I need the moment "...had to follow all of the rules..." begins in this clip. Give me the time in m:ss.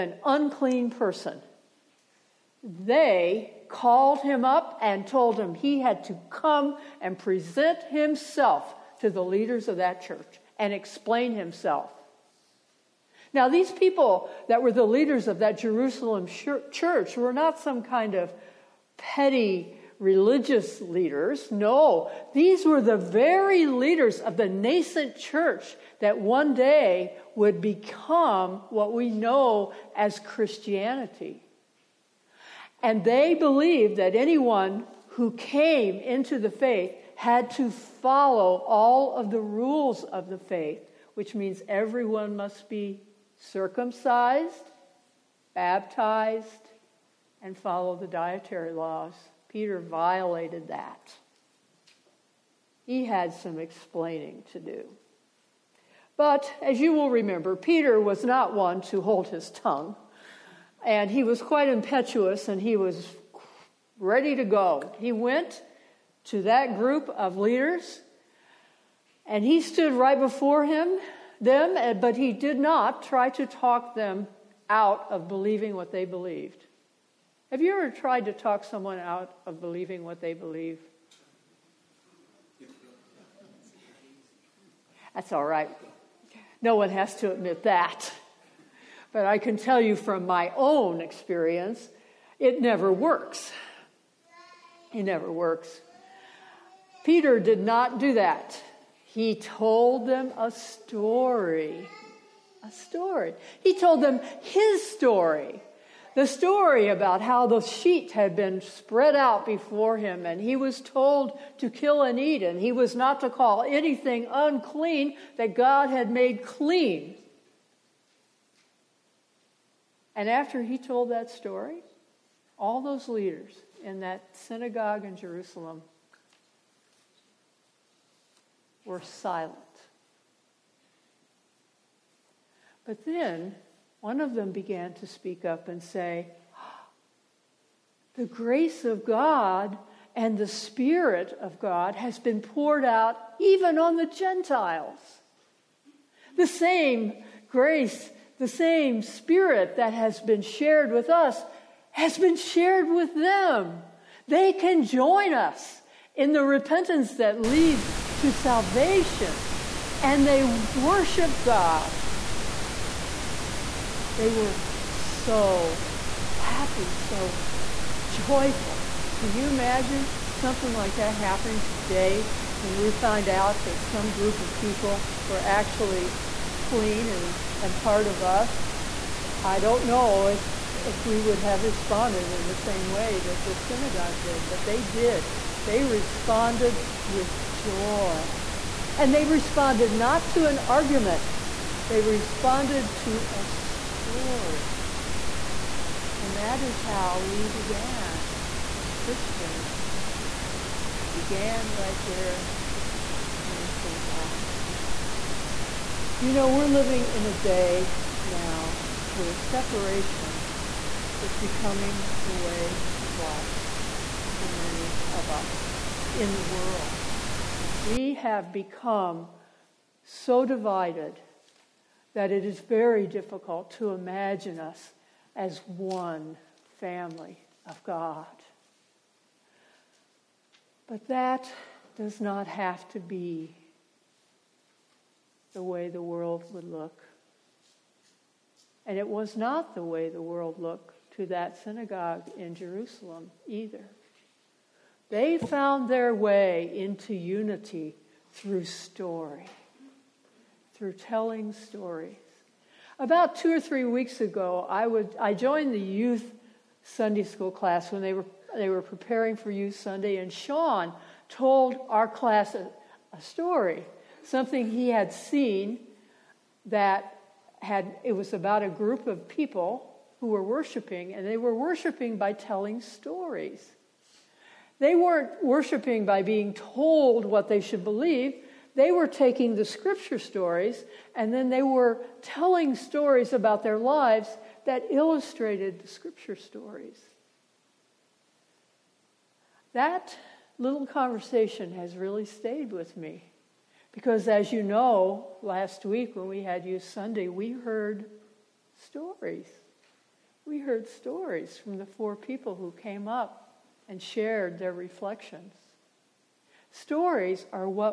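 0:37.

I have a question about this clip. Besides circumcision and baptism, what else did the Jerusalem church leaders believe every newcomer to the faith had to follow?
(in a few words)
dietary laws.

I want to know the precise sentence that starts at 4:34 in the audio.
They weren't worshiping by being told what they should believe.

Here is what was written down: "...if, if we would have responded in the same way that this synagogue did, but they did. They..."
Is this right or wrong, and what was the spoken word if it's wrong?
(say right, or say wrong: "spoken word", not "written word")
right.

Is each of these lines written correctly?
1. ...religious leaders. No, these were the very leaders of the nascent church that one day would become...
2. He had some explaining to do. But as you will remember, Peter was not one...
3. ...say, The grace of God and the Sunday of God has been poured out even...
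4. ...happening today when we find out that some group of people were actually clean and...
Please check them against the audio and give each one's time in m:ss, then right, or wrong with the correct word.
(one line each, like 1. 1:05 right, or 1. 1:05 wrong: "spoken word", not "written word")
1. 0:20 right
2. 0:52 right
3. 2:15 wrong: "Spirit", not "Sunday"
4. 2:51 right.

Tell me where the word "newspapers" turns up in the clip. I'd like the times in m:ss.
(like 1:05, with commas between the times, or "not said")
not said.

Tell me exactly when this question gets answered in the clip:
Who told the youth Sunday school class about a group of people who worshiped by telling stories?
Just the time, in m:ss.
4:20.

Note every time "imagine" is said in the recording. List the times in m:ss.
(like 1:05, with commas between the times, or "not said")
2:49, 3:43.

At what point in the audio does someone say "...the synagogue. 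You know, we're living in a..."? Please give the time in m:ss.
3:23.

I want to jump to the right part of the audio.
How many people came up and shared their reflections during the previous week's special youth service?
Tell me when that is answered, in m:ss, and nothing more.
5:01.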